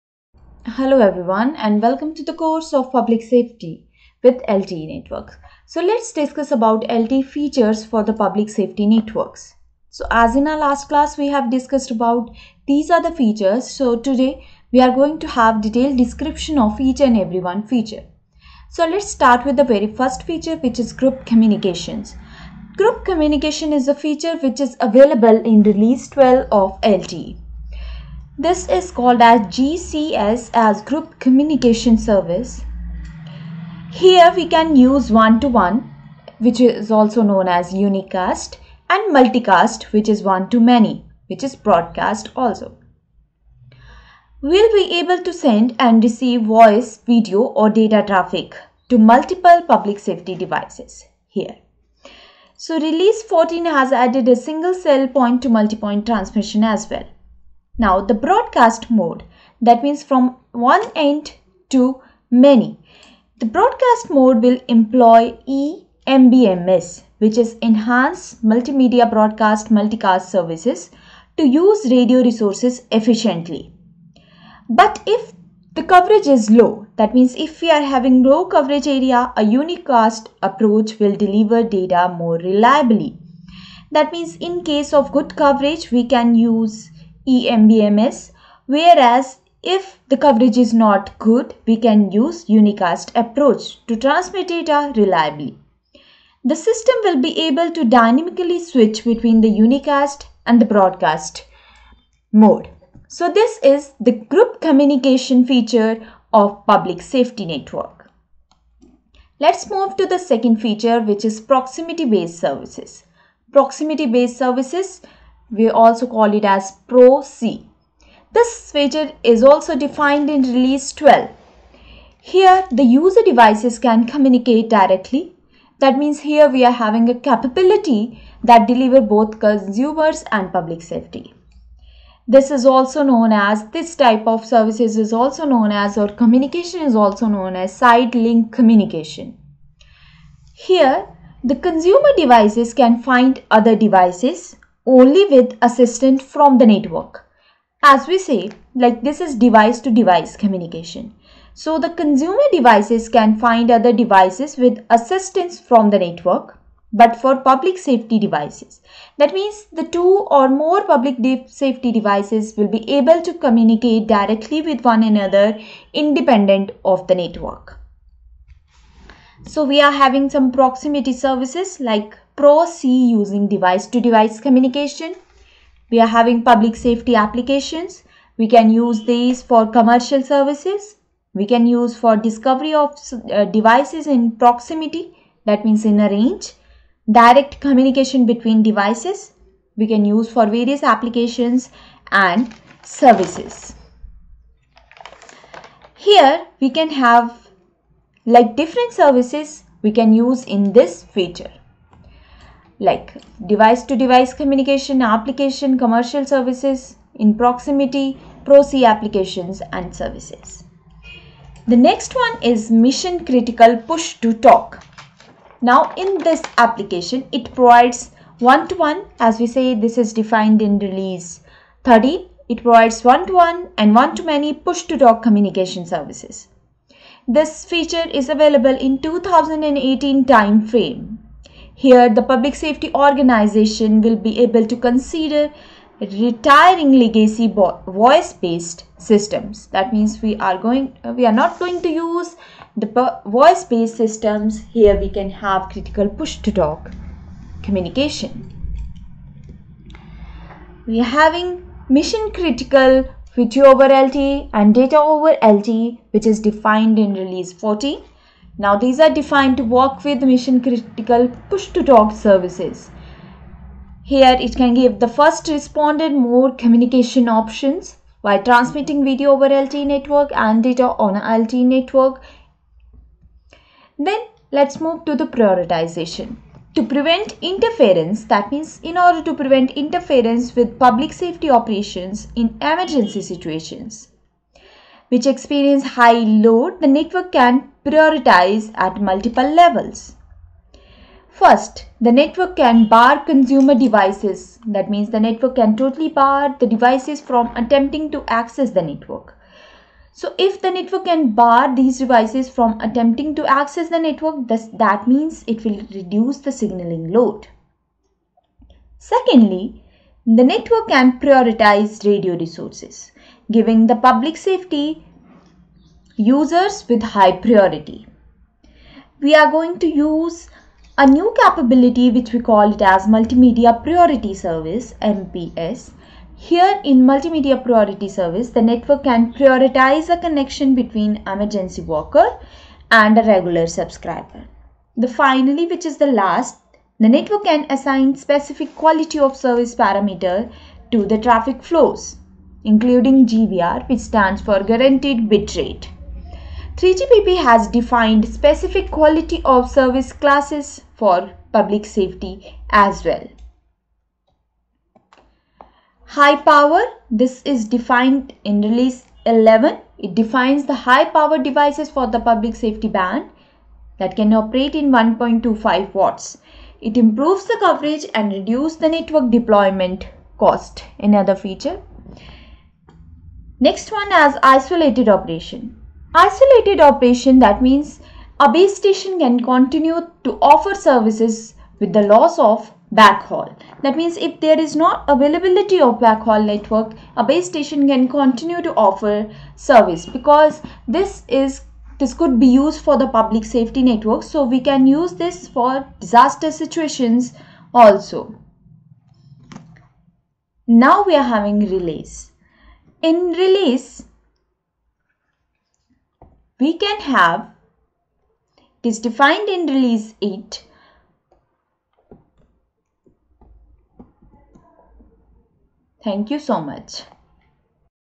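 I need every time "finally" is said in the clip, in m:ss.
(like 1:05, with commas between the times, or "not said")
5:35.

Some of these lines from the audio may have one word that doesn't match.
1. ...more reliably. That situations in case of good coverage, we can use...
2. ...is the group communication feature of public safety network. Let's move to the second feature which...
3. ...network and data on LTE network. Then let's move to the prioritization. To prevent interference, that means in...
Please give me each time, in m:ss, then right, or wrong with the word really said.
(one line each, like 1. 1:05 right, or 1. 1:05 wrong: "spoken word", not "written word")
1. 1:22 wrong: "means", not "situations"
2. 1:43 right
3. 4:29 right.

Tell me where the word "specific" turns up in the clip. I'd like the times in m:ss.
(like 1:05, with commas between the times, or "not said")
5:38, 5:48.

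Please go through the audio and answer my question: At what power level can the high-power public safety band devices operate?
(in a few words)
1.25 watts.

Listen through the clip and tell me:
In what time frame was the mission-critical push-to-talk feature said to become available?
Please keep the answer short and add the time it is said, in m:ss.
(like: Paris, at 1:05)
2018, at 3:49.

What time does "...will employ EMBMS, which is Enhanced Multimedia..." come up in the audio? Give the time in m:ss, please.
1:04.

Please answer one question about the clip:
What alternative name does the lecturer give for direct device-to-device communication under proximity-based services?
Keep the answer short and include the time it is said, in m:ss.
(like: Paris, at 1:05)
side link communication, at 2:17.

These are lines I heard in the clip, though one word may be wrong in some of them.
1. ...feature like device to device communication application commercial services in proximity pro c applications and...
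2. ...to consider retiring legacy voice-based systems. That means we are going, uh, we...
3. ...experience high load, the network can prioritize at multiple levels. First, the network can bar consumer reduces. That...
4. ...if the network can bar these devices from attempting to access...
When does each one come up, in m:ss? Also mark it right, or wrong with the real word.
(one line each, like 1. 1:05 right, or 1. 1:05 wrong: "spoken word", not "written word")
1. 3:21 right
2. 3:54 right
3. 4:45 wrong: "devices", not "reduces"
4. 5:00 right.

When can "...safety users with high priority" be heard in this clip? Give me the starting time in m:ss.
5:14.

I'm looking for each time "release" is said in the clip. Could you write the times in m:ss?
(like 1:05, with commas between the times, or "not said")
0:25, 0:52, 2:00, 3:40, 4:17, 5:58, 6:43, 6:49.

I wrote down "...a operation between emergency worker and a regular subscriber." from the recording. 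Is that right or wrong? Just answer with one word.
wrong.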